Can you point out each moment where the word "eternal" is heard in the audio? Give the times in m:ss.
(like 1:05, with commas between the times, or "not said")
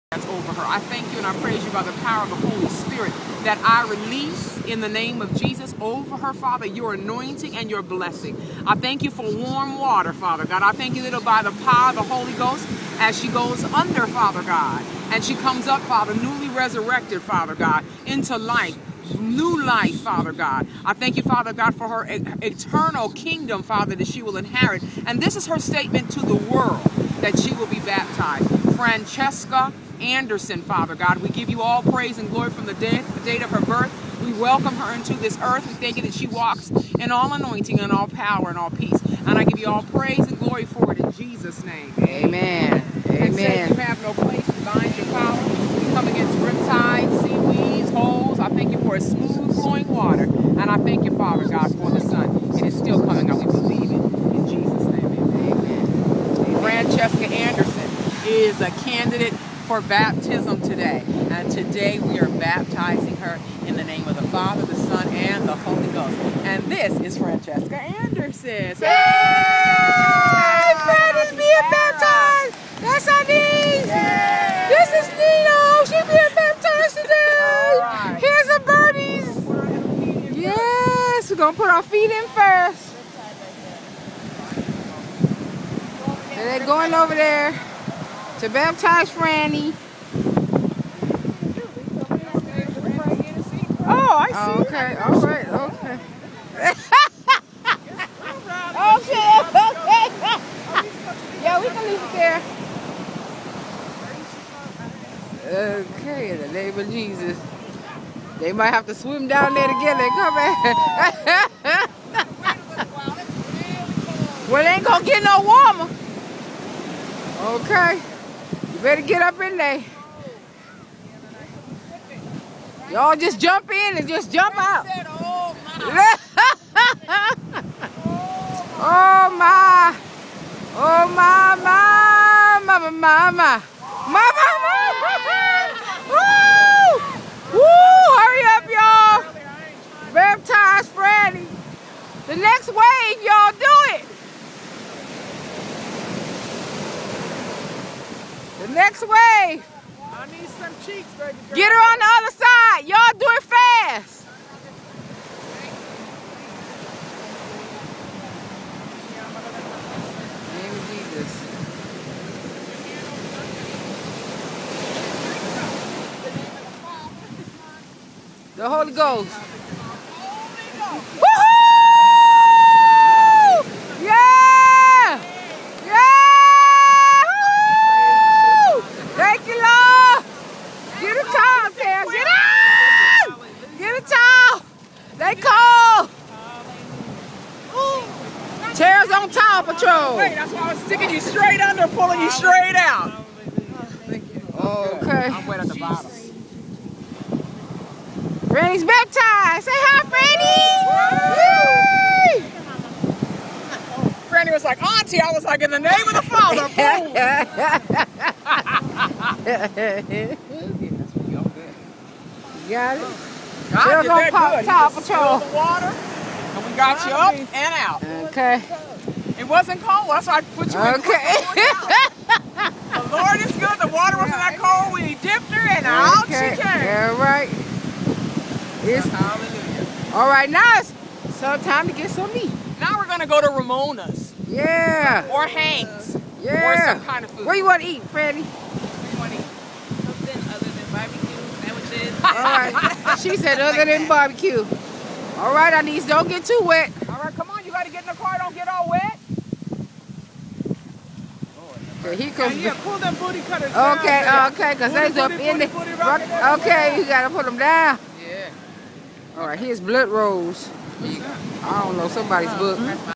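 0:22.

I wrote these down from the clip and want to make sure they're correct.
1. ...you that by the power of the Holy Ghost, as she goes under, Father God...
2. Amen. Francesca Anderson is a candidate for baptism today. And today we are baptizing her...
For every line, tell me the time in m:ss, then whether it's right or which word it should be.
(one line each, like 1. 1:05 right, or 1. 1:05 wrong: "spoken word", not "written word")
1. 0:10 right
2. 0:56 right.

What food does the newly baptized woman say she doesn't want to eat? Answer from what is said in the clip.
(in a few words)
Barbecue sandwiches.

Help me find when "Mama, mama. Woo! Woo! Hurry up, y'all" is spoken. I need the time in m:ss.
2:14.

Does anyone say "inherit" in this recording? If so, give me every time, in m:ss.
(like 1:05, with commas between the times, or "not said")
0:24.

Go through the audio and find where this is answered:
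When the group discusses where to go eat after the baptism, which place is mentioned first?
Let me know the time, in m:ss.
3:53.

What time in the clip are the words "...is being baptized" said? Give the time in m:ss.
1:11.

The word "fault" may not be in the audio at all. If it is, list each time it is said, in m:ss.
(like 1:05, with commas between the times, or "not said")
not said.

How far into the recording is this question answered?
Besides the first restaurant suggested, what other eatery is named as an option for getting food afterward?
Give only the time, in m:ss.
3:55.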